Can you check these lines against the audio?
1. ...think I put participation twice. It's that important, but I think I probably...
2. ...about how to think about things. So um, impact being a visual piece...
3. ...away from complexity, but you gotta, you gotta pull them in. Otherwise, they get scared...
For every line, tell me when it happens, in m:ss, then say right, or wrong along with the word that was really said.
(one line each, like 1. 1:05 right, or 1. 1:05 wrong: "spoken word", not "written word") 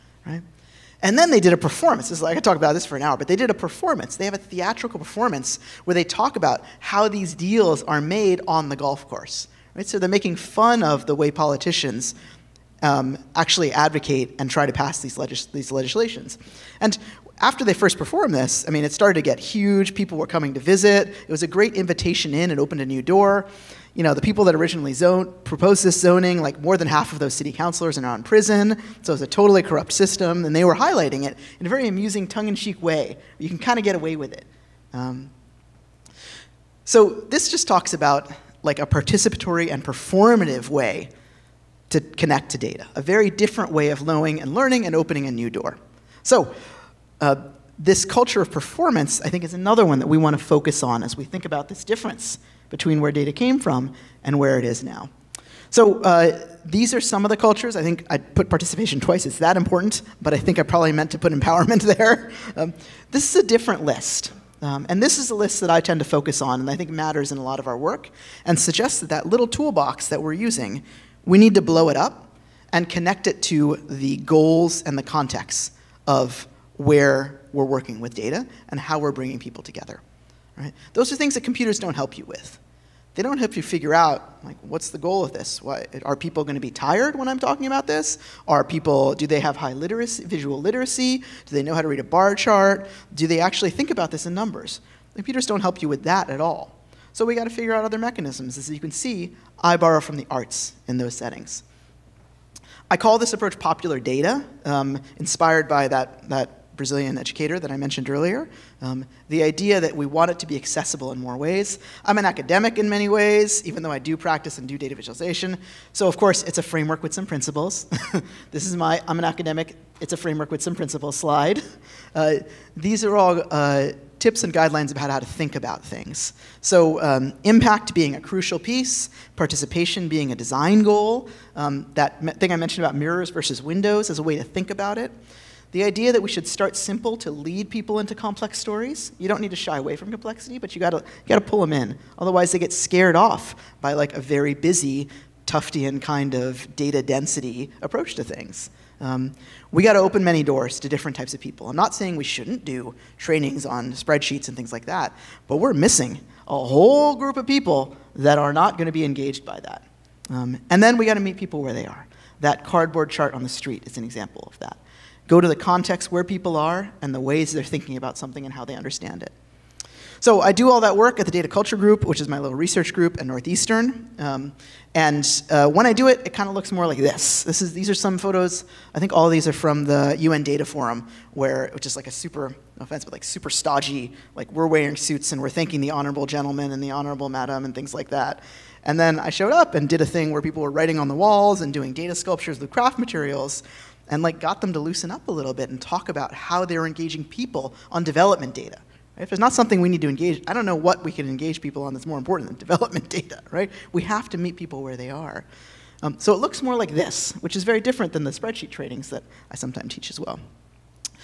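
1. 0:57 right
2. 2:04 wrong: "crucial", not "visual"
3. 2:19 right.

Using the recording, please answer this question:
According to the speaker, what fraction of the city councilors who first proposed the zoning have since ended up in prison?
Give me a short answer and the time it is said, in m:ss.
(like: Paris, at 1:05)
more than half, at 0:26.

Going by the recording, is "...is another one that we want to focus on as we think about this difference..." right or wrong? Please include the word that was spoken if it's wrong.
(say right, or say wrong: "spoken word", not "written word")
right.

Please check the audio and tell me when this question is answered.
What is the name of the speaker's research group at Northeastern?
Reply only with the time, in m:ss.
2:51.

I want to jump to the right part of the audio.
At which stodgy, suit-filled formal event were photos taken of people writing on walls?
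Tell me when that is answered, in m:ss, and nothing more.
3:00.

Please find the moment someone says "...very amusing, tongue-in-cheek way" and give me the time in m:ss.
0:31.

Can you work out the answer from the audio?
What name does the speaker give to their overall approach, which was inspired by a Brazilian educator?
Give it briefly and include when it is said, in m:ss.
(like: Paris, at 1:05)
popular data, at 1:43.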